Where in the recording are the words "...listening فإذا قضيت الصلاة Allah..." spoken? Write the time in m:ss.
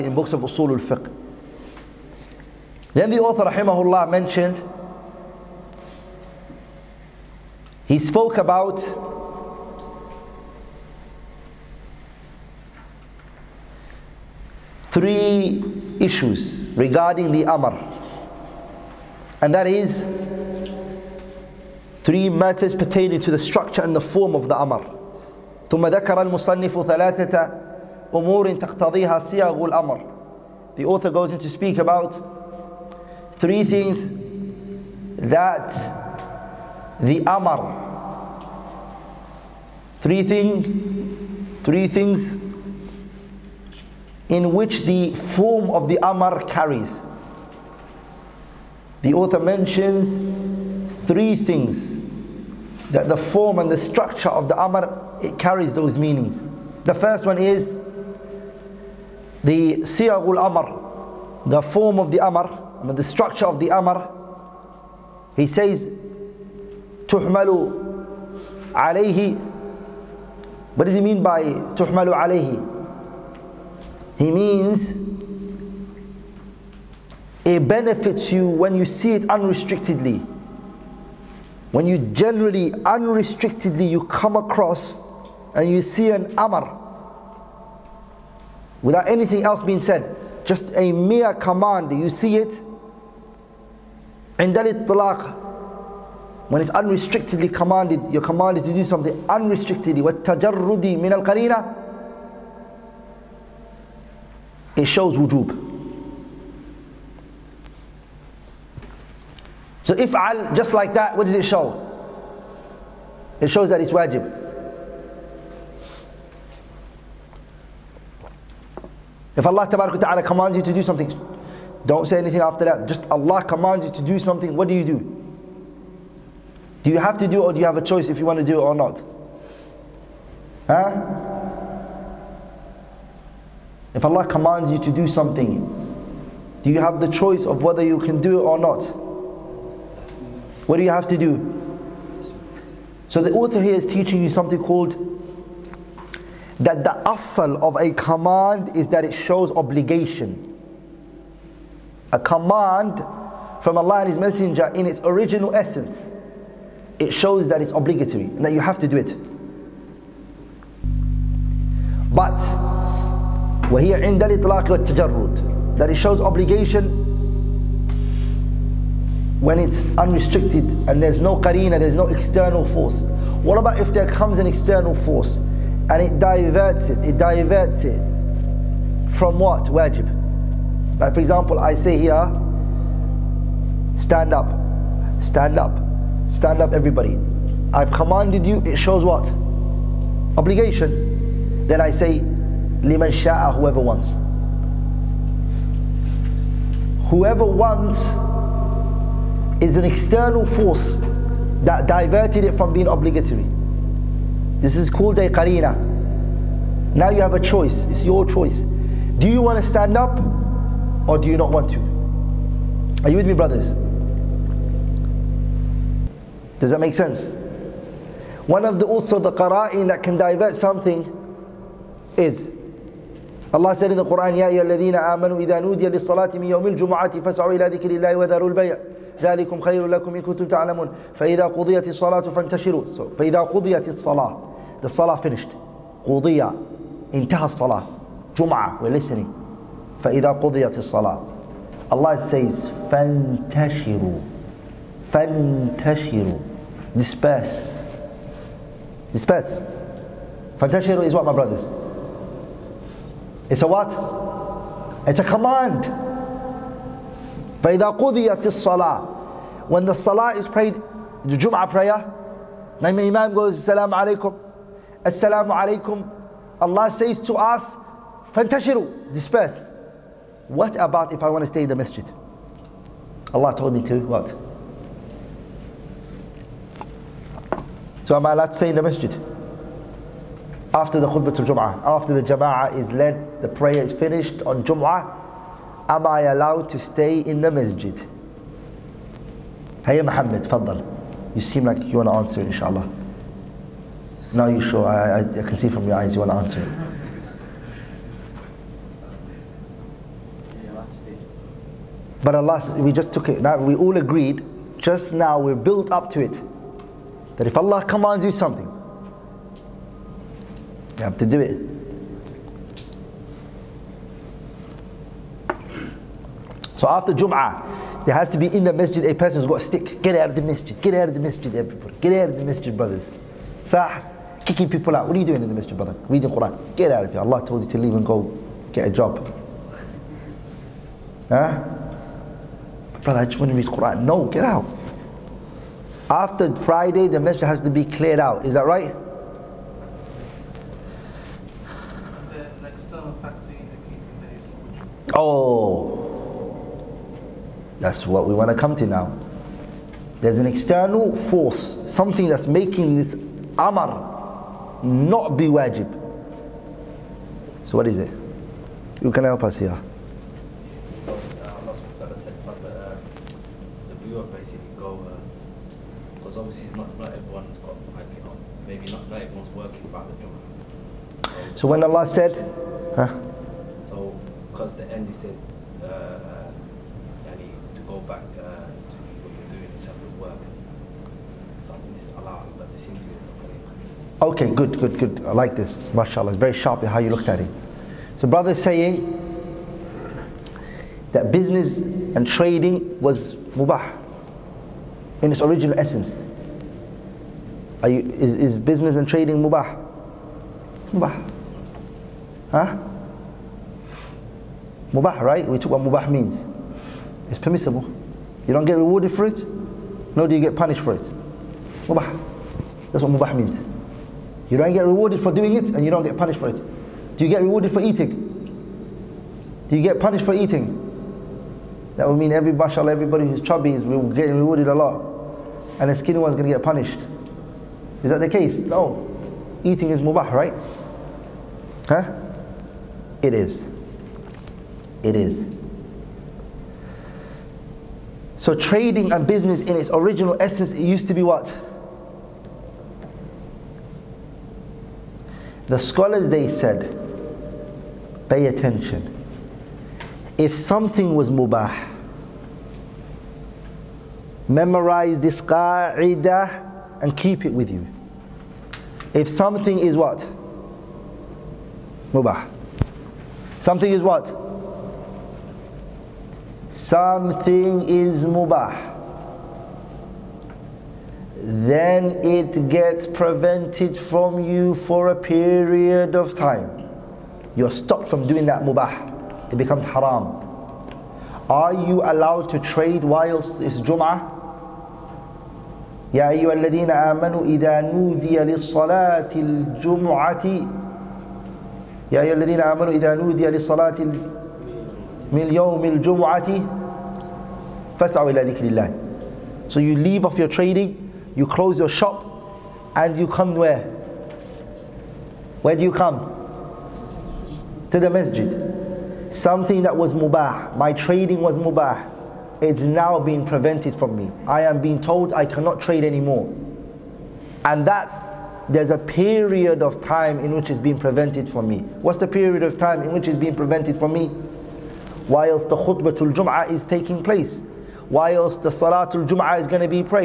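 3:58.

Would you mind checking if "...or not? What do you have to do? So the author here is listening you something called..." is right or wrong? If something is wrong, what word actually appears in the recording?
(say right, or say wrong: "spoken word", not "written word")
wrong: "teaching", not "listening".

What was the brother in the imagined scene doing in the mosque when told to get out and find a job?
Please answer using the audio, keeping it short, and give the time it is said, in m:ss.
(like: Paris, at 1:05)
Reading Quran, at 5:26.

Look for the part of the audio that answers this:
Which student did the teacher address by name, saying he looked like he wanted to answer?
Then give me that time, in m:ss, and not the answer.
4:50.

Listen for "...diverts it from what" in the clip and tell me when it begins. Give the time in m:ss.
2:57.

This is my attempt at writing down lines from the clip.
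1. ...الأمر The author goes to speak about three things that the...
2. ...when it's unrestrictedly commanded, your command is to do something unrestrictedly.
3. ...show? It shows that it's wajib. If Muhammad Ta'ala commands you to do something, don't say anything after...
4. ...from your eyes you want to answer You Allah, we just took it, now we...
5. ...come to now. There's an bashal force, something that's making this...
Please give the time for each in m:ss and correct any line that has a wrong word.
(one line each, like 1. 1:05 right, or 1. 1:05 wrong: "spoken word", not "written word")
1. 0:29 right
2. 1:36 right
3. 1:51 wrong: "Allah", not "Muhammad"
4. 4:55 wrong: "But", not "You"
5. 5:48 wrong: "external", not "bashal".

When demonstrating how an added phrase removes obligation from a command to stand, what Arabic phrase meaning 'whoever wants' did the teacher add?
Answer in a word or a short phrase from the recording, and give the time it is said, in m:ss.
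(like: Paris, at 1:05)
liman sha'a, at 3:12.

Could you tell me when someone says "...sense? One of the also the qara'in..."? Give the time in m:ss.
3:36.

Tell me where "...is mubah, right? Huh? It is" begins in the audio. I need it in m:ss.
7:09.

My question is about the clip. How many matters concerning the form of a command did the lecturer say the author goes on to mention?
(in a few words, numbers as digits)
3.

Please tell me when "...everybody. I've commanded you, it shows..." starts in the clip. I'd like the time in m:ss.
3:06.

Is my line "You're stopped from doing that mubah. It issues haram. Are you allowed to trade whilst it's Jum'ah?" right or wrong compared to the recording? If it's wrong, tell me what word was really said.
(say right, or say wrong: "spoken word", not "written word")
wrong: "becomes", not "issues".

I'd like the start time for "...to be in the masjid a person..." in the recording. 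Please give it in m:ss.
5:18.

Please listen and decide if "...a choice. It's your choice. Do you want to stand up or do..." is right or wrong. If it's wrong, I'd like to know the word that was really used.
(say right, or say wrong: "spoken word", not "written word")
right.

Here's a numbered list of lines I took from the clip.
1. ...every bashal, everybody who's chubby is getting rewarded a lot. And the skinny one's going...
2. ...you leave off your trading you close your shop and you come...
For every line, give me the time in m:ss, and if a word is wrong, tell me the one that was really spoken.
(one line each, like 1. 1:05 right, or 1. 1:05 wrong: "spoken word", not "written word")
1. 7:02 right
2. 8:19 right.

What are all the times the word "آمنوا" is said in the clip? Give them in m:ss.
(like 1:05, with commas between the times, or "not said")
8:06, 8:12.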